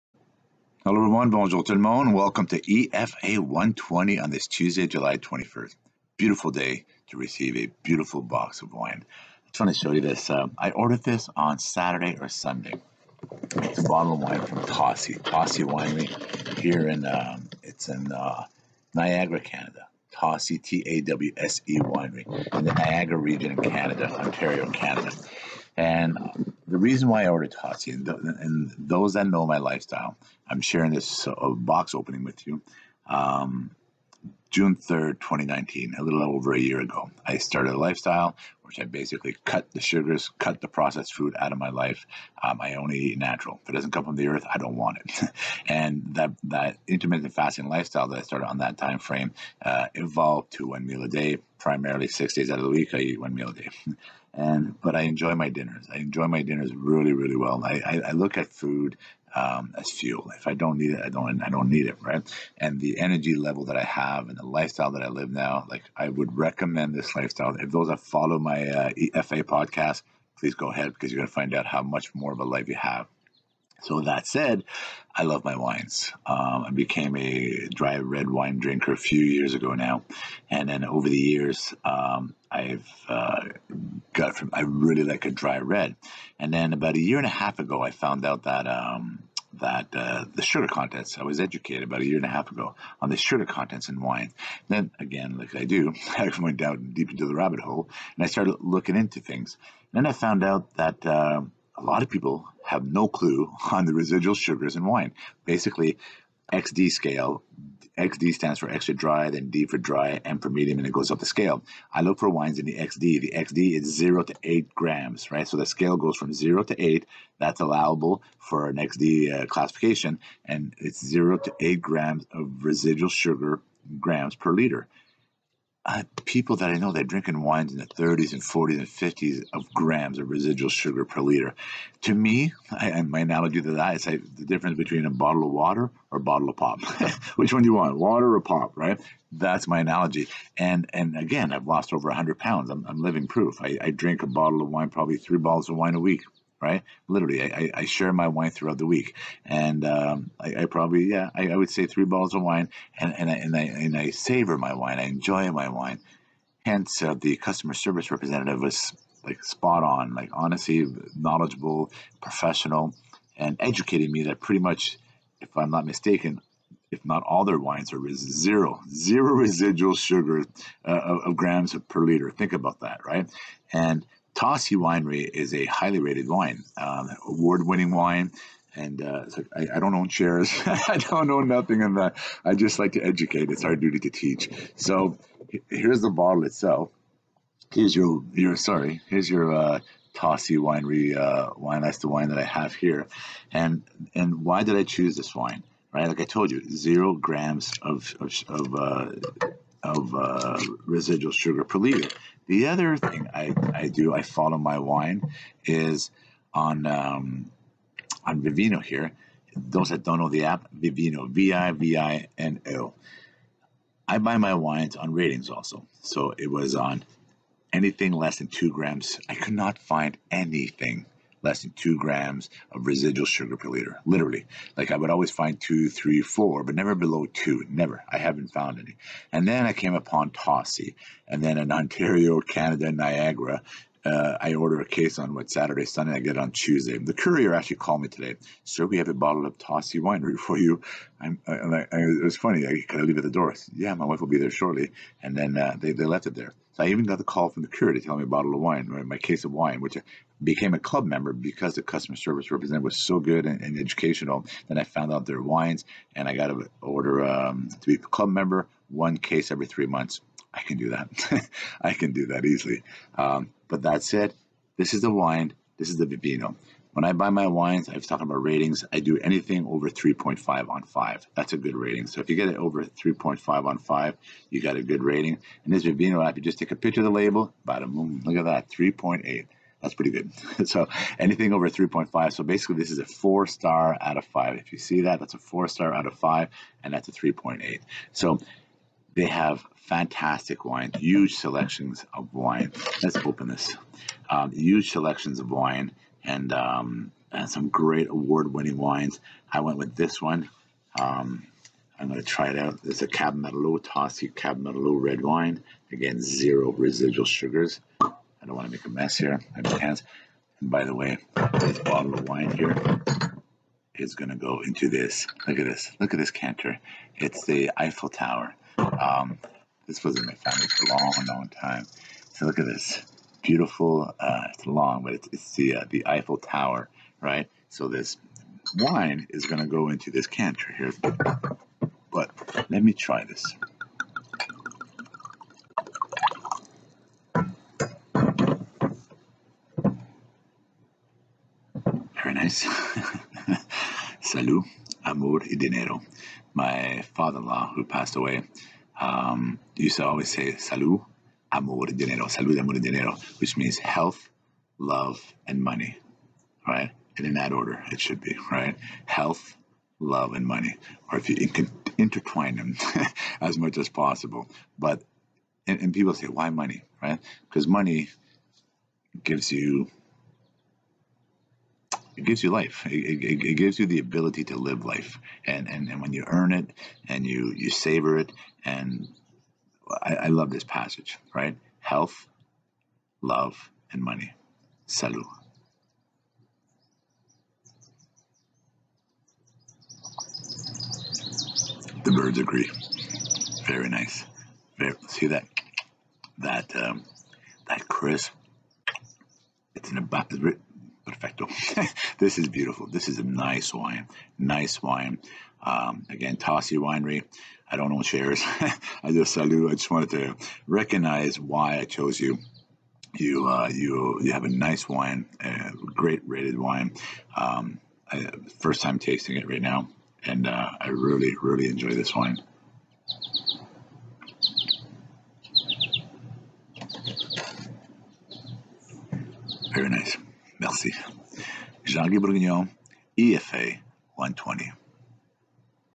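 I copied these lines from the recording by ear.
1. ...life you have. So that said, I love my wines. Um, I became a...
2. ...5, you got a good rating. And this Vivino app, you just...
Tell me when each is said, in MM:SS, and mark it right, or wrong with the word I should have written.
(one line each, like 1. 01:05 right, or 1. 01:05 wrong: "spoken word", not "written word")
1. 01:12 right
2. 04:33 right.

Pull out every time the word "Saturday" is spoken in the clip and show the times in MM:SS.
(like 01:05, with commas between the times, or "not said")
00:11, 03:55.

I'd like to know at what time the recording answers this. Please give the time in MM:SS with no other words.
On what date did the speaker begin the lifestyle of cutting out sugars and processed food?
00:34.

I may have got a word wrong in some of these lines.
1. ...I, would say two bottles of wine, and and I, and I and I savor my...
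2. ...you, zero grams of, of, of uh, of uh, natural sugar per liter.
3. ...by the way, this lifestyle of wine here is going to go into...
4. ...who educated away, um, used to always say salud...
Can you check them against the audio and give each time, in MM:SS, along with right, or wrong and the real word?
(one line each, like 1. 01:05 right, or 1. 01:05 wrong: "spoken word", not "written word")
1. 02:31 wrong: "three", not "two"
2. 03:16 wrong: "residual", not "natural"
3. 05:10 wrong: "bottle", not "lifestyle"
4. 05:47 wrong: "passed", not "educated".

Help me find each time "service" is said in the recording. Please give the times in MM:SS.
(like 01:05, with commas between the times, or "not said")
02:37, 04:12.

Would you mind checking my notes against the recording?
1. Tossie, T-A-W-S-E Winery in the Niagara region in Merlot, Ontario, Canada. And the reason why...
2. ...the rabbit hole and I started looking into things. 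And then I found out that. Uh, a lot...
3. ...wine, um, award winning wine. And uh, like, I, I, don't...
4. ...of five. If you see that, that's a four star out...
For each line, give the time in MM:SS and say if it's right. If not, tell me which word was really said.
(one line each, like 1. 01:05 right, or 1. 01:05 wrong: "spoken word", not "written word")
1. 00:20 wrong: "Canada", not "Merlot"
2. 01:37 right
3. 02:56 right
4. 04:44 right.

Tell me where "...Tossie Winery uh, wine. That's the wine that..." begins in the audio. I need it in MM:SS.
03:10.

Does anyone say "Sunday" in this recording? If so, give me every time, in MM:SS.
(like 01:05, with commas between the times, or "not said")
00:12, 03:55.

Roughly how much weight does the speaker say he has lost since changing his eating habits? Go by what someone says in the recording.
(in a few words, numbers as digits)
over 100 pounds.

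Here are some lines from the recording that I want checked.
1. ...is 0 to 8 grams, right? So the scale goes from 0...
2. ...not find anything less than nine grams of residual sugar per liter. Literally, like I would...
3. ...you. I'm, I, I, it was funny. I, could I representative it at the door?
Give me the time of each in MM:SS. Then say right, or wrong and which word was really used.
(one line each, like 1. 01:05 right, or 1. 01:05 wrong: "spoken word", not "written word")
1. 01:53 right
2. 03:39 wrong: "two", not "nine"
3. 04:00 wrong: "leave", not "representative".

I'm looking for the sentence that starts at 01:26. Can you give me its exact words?
And then about a year and a half ago, I found out that um, that uh, the sugar contents.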